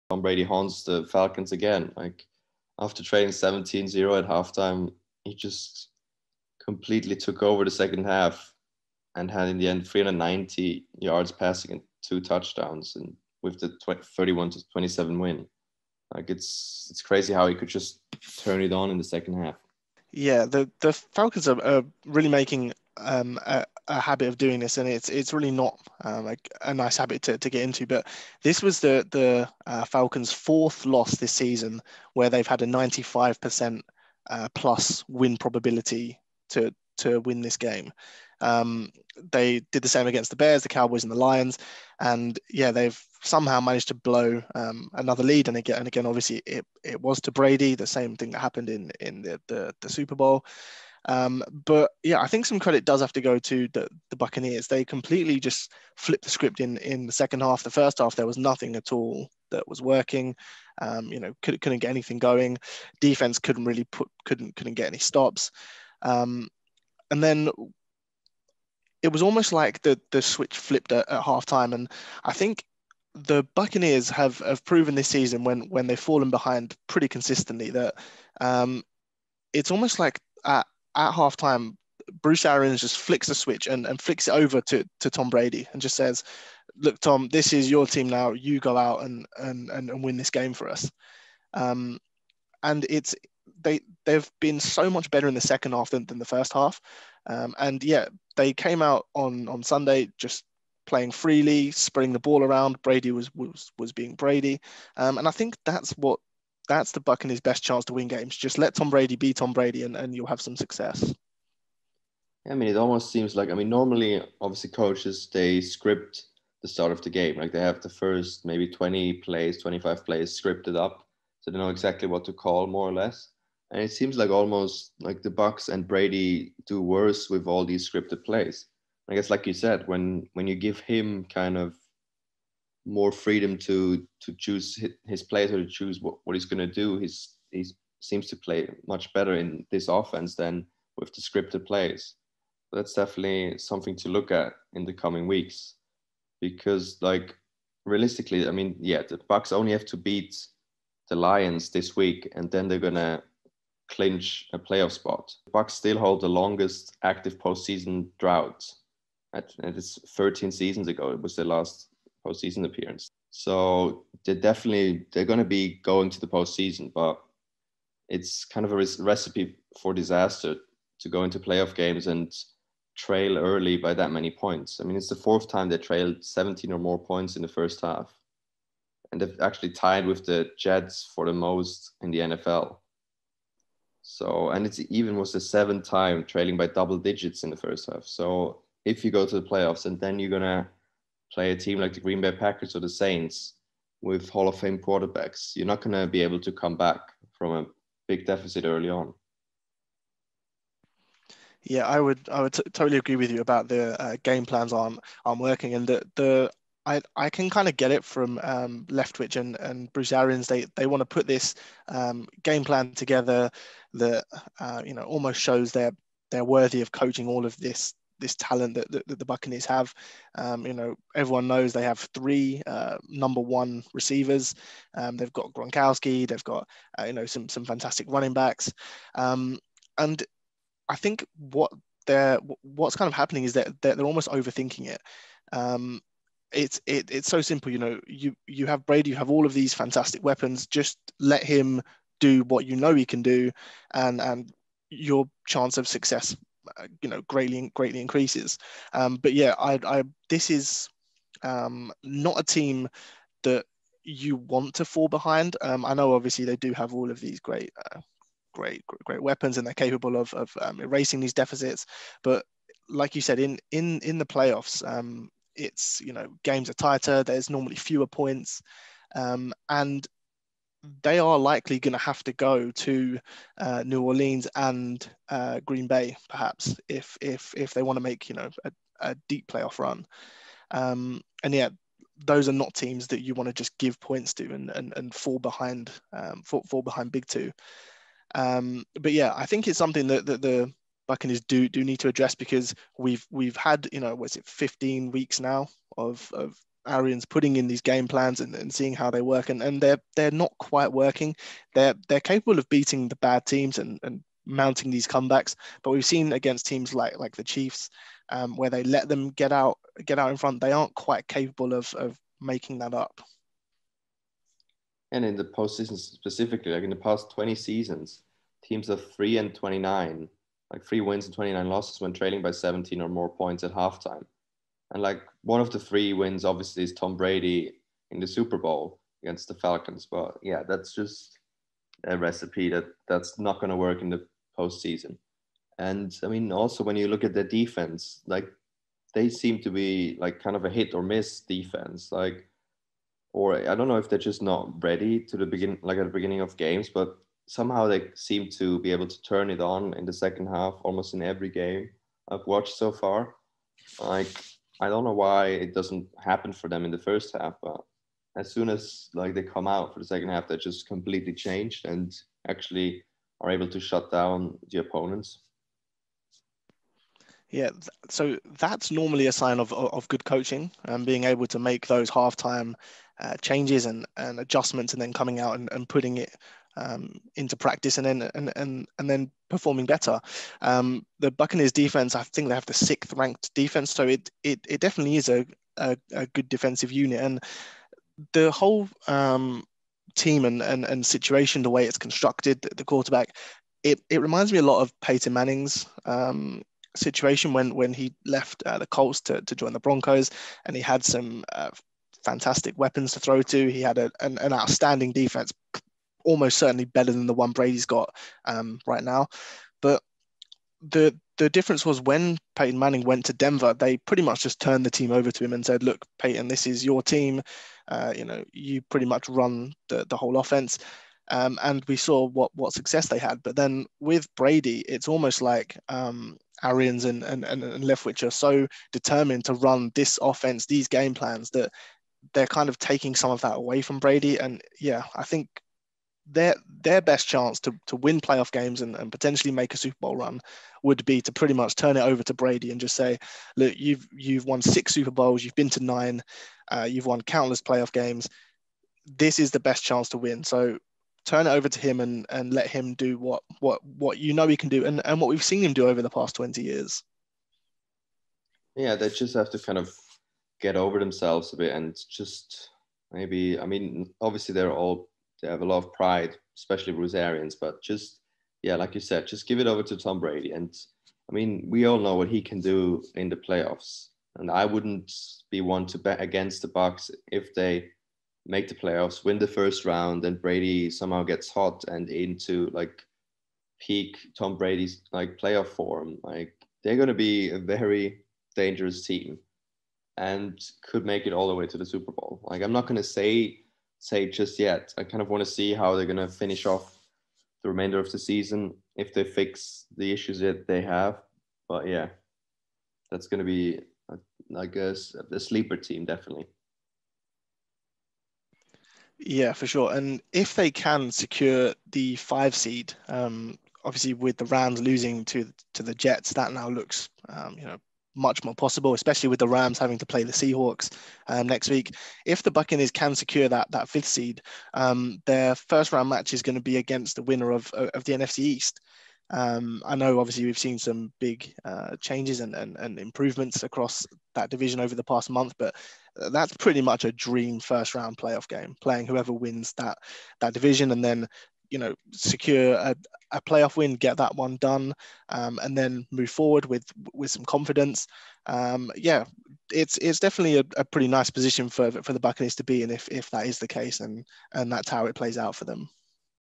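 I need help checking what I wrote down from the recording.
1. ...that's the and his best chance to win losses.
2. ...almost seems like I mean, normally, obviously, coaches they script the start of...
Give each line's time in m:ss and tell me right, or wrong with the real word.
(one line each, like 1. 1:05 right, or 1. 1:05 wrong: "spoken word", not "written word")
1. 1:46 wrong: "games", not "losses"
2. 1:52 right.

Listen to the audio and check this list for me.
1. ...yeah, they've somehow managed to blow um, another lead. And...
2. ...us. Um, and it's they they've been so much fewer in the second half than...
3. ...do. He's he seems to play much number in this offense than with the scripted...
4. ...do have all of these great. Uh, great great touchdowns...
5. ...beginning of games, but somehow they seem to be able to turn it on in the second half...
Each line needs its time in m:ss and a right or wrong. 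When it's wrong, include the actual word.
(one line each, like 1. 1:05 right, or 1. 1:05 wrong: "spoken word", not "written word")
1. 0:42 right
2. 1:30 wrong: "better", not "fewer"
3. 2:16 wrong: "better", not "number"
4. 4:16 wrong: "weapons", not "touchdowns"
5. 5:46 right.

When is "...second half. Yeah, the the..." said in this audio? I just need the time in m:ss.
0:19.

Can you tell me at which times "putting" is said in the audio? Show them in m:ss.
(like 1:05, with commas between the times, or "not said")
4:57, 6:15.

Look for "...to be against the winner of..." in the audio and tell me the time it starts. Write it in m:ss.
8:46.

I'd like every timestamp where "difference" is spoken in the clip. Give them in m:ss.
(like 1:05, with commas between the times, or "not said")
6:51.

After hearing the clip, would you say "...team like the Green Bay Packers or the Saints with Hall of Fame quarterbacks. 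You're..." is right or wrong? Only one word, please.
right.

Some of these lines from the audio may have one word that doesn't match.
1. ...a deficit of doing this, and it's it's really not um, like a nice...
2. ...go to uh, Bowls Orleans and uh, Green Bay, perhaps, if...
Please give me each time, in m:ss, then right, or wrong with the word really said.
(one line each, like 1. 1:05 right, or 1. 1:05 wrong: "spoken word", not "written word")
1. 0:23 wrong: "habit", not "deficit"
2. 4:32 wrong: "New", not "Bowls".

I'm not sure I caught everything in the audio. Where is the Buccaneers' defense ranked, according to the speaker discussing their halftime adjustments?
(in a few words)
6th.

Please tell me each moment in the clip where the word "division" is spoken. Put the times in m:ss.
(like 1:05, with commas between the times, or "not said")
8:54, 9:00.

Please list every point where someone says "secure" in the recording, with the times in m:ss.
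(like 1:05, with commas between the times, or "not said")
8:31, 8:43, 9:02.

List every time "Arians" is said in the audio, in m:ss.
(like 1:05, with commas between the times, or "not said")
1:22, 3:30, 4:56, 7:06, 7:47.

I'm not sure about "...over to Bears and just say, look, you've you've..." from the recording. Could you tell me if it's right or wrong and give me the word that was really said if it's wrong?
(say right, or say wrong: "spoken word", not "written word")
wrong: "Brady", not "Bears".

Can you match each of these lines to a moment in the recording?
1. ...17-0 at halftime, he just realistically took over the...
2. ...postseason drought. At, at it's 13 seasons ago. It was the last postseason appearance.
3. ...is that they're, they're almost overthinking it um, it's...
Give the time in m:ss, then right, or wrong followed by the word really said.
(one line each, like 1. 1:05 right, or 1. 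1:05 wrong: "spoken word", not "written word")
1. 0:03 wrong: "completely", not "realistically"
2. 2:37 right
3. 3:53 right.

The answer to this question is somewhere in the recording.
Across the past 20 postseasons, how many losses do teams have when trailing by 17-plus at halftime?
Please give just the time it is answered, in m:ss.
5:21.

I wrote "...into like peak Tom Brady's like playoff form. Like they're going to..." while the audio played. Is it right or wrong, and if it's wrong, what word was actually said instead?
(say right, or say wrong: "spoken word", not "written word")
right.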